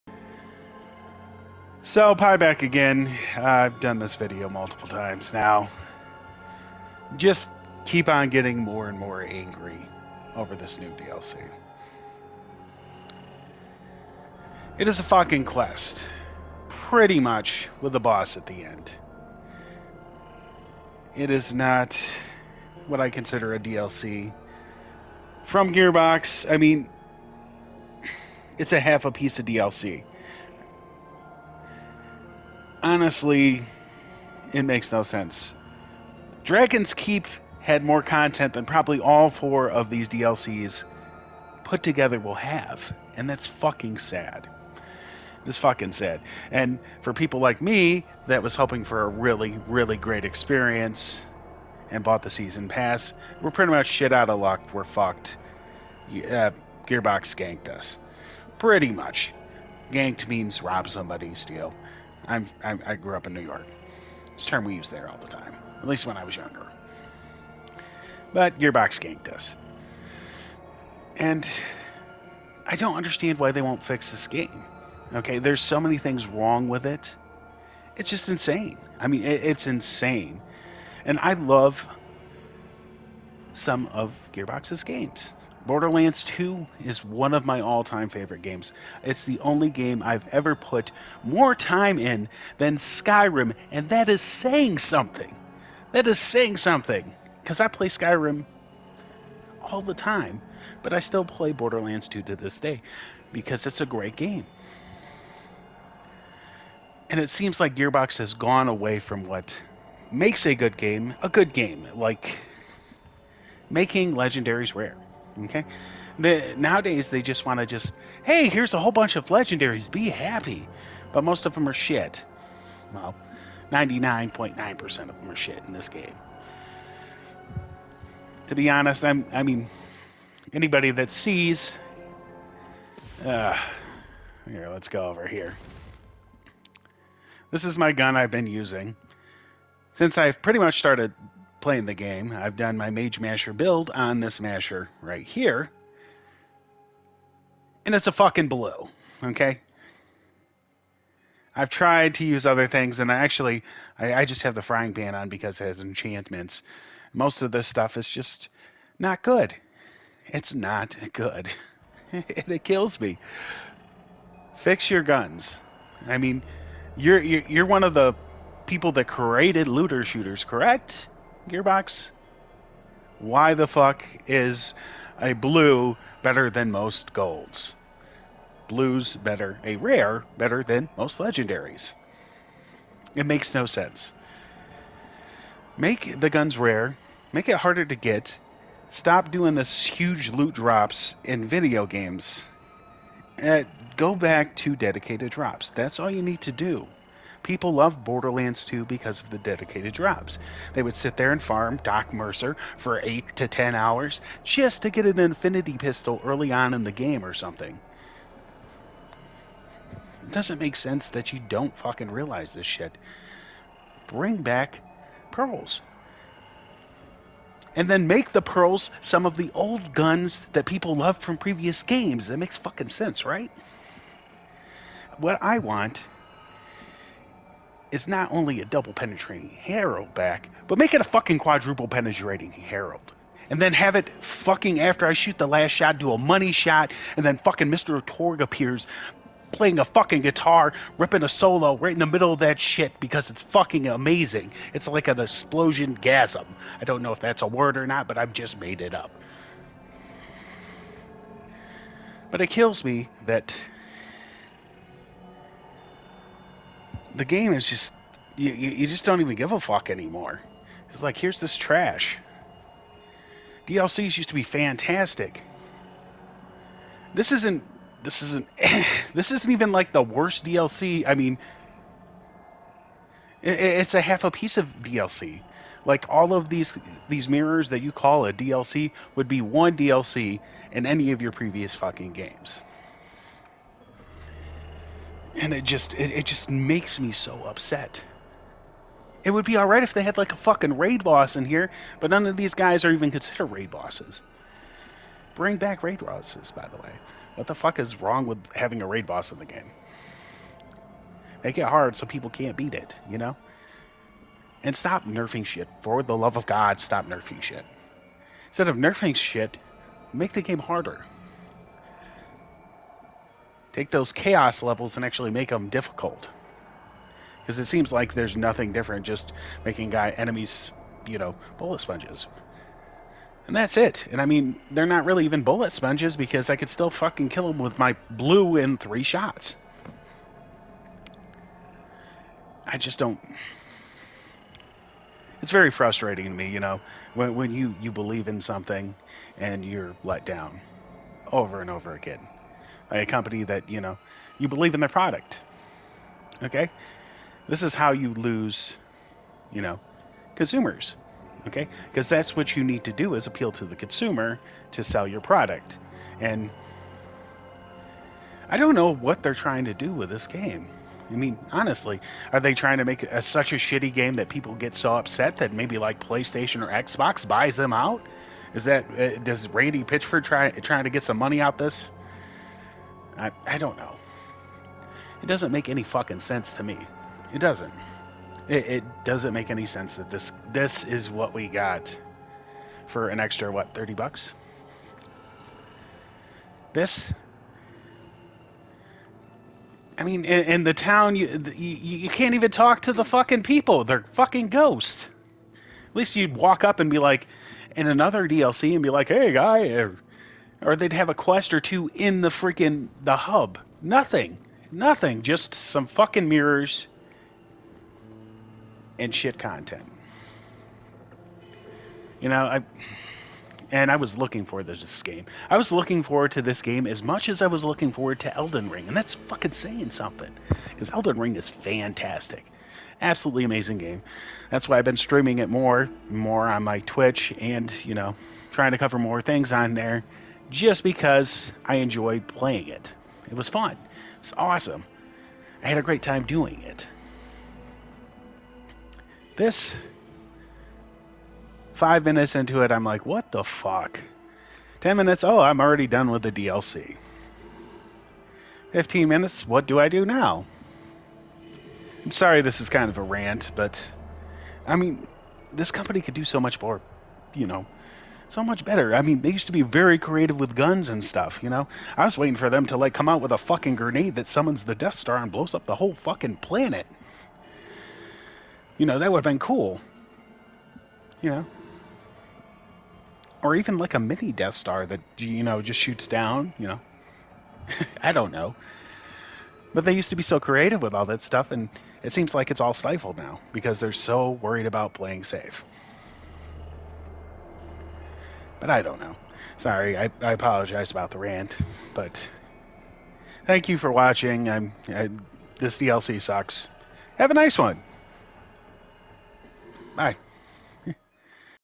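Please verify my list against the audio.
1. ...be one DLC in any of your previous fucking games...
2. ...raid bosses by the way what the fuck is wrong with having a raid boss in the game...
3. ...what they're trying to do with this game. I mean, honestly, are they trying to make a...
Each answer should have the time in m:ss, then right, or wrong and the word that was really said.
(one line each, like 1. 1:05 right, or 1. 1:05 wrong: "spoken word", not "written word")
1. 4:39 right
2. 4:55 right
3. 5:58 right.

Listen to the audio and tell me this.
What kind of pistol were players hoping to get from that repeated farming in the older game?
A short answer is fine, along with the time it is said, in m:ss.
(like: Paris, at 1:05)
infinity pistol, at 3:25.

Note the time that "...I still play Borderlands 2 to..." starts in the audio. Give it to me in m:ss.
1:40.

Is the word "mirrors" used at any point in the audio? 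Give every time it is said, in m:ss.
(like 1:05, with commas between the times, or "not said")
4:37, 6:46.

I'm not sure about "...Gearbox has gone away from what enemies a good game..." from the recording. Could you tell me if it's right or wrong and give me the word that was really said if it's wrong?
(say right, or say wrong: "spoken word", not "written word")
wrong: "makes", not "enemies".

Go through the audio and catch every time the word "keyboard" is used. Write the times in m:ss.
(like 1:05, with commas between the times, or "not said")
not said.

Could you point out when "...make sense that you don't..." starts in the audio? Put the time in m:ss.
3:30.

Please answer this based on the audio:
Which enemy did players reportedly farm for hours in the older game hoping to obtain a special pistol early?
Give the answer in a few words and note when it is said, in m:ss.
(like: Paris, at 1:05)
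Doc Mercy, at 3:21.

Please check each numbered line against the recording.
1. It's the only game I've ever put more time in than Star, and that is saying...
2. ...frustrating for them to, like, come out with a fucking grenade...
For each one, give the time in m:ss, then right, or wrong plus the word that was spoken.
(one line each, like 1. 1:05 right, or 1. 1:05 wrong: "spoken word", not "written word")
1. 1:29 wrong: "Skyrim", not "Star"
2. 7:42 wrong: "waiting", not "frustrating".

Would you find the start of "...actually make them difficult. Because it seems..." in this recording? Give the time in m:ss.
5:15.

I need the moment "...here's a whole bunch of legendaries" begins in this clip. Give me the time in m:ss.
1:58.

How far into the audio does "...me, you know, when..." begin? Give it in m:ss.
5:36.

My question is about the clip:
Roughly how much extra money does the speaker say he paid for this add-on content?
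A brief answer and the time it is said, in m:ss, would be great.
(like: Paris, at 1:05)
30 bucks, at 6:23.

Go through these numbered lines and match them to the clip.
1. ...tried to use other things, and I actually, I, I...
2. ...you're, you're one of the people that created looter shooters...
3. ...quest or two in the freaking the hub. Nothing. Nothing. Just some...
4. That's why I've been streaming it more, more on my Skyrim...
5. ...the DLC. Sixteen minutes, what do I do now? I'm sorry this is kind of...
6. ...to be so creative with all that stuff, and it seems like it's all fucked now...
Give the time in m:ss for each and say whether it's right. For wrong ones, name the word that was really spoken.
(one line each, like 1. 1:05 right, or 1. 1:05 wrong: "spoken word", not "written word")
1. 2:31 right
2. 2:47 right
3. 6:41 right
4. 7:04 wrong: "Twitch", not "Skyrim"
5. 7:26 wrong: "Fifteen", not "Sixteen"
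6. 8:00 wrong: "stifled", not "fucked".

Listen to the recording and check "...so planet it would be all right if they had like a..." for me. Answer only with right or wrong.
wrong.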